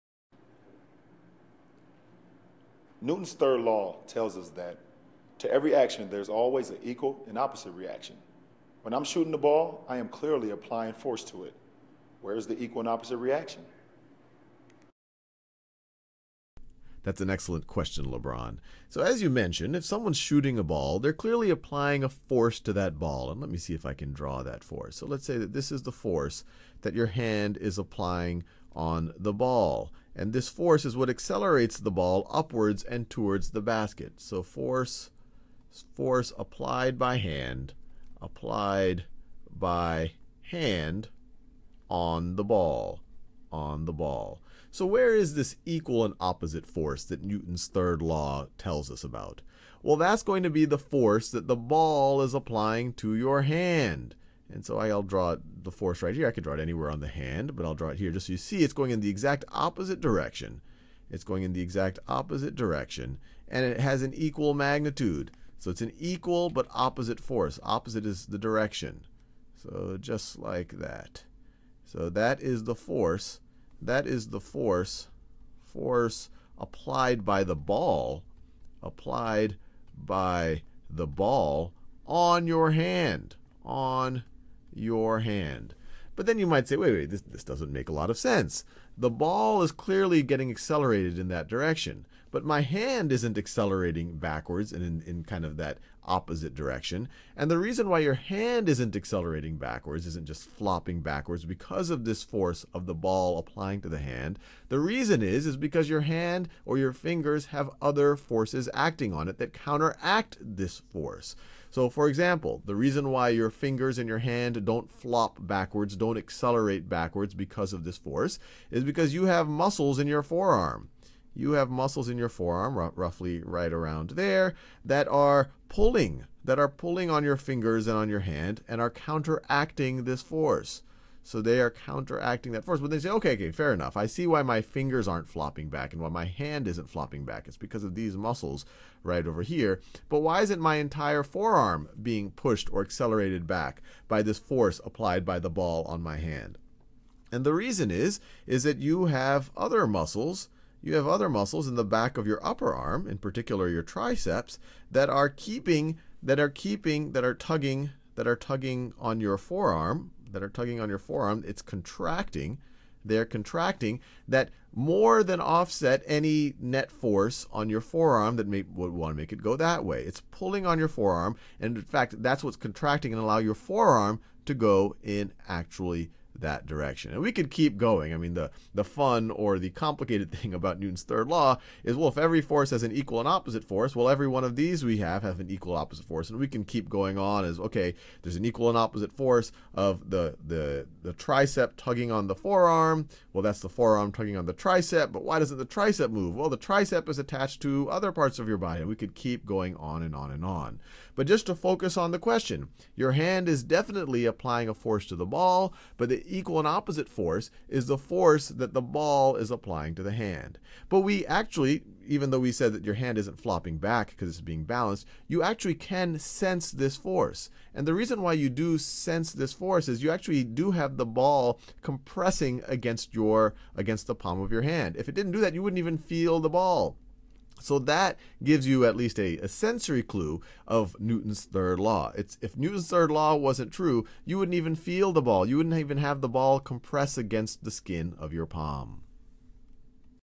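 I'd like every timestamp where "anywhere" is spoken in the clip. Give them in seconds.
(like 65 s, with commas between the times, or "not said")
56 s.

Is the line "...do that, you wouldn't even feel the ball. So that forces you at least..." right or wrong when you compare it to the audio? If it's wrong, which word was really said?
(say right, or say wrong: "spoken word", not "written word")
wrong: "gives", not "forces".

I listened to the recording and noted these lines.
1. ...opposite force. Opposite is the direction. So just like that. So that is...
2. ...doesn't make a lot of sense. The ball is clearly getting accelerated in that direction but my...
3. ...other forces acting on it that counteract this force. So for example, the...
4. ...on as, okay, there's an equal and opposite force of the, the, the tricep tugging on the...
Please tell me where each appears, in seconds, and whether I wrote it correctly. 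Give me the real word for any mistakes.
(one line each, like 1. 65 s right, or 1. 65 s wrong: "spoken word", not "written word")
1. 66 s right
2. 87 s right
3. 107 s right
4. 187 s right.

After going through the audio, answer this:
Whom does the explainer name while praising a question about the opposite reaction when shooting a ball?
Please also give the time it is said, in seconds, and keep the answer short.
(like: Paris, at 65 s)
LeBron, at 18 s.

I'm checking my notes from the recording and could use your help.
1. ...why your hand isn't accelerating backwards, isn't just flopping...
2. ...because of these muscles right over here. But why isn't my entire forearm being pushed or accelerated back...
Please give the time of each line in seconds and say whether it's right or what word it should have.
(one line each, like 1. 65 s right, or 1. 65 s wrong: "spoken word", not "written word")
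1. 97 s right
2. 137 s right.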